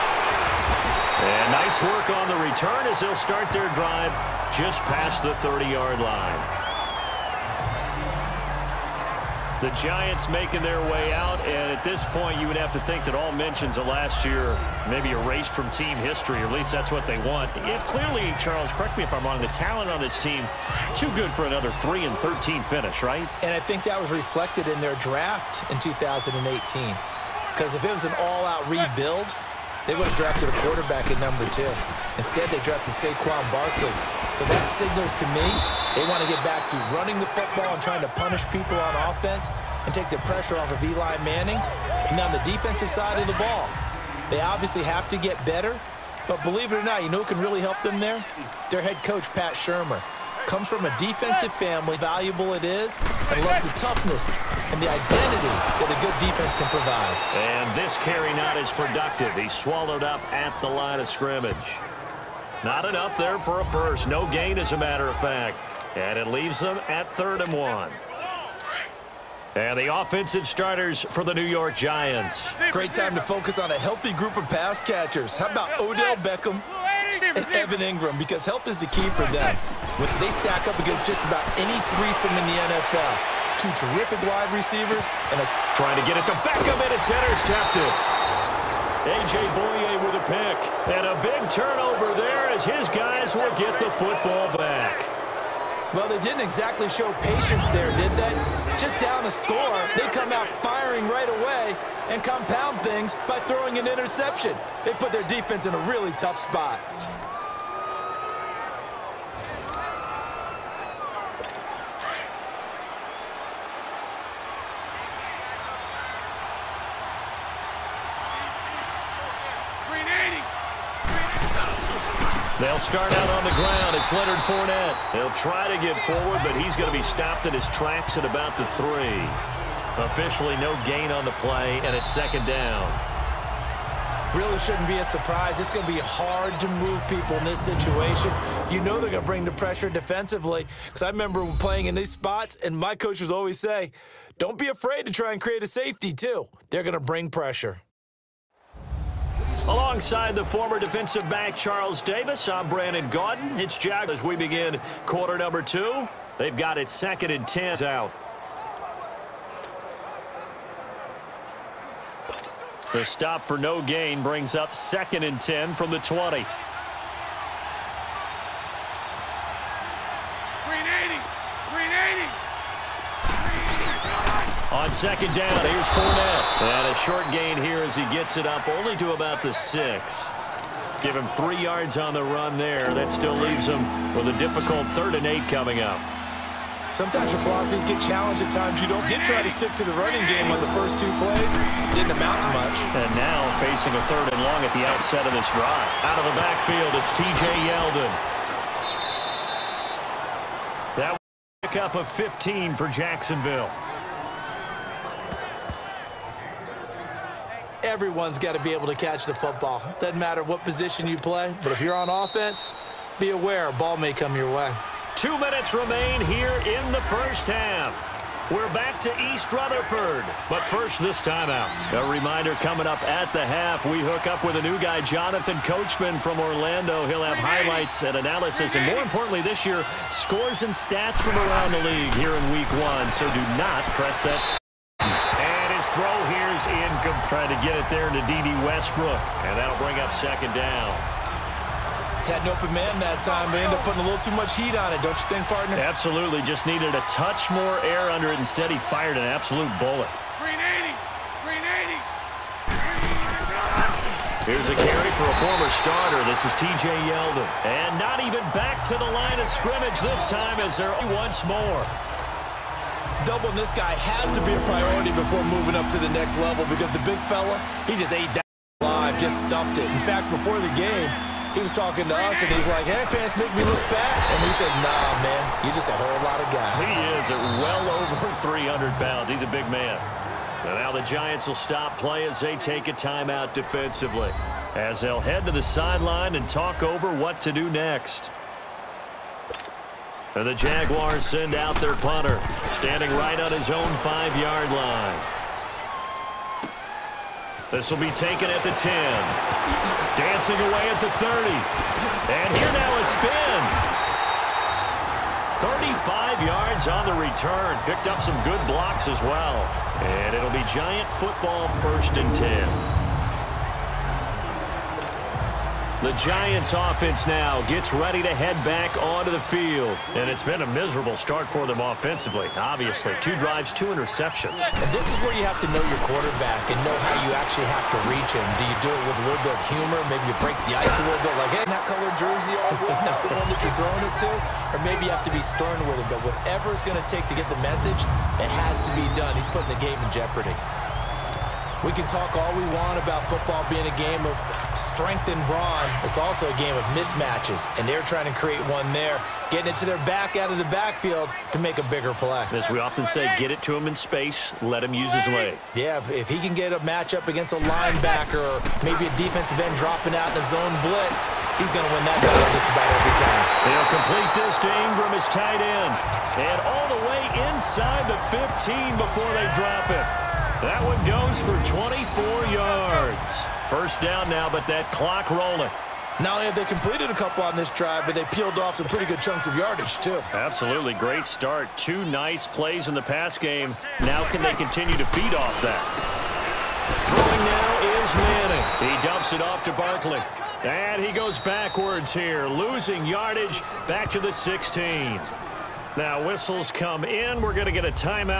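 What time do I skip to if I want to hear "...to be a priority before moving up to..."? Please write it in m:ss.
4:24.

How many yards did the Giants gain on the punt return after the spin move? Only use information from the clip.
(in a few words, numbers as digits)
35.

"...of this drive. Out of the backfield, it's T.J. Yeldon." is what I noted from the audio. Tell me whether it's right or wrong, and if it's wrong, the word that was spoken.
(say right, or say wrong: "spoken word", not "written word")
right.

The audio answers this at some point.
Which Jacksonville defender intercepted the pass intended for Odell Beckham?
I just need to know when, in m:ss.
1:27.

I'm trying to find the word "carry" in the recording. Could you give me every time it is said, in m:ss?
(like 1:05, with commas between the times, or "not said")
0:57, 4:14.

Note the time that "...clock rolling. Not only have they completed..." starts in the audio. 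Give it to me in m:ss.
6:14.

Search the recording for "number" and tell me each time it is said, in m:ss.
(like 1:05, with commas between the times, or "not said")
0:31, 2:35.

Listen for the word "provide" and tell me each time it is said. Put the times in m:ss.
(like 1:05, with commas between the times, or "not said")
0:56.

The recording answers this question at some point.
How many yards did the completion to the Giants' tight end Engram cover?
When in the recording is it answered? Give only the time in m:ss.
6:11.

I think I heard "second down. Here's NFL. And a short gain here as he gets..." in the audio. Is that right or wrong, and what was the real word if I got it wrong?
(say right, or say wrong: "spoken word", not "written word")
wrong: "Fournette", not "NFL".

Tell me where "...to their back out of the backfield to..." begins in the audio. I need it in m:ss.
5:49.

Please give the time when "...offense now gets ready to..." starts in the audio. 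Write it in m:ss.
5:16.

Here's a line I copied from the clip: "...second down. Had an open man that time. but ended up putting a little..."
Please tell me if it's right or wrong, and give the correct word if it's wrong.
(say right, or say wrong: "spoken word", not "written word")
right.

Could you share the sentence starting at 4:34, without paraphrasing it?
And we said, nah, man, you're just a whole lot of guy.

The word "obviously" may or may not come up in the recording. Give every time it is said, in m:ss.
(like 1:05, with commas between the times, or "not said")
0:44, 5:22.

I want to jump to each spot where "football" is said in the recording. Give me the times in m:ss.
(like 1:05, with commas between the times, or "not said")
0:37, 1:33, 3:29, 5:11, 5:43.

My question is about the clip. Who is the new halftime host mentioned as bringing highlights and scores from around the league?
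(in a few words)
Jonathan Coachman.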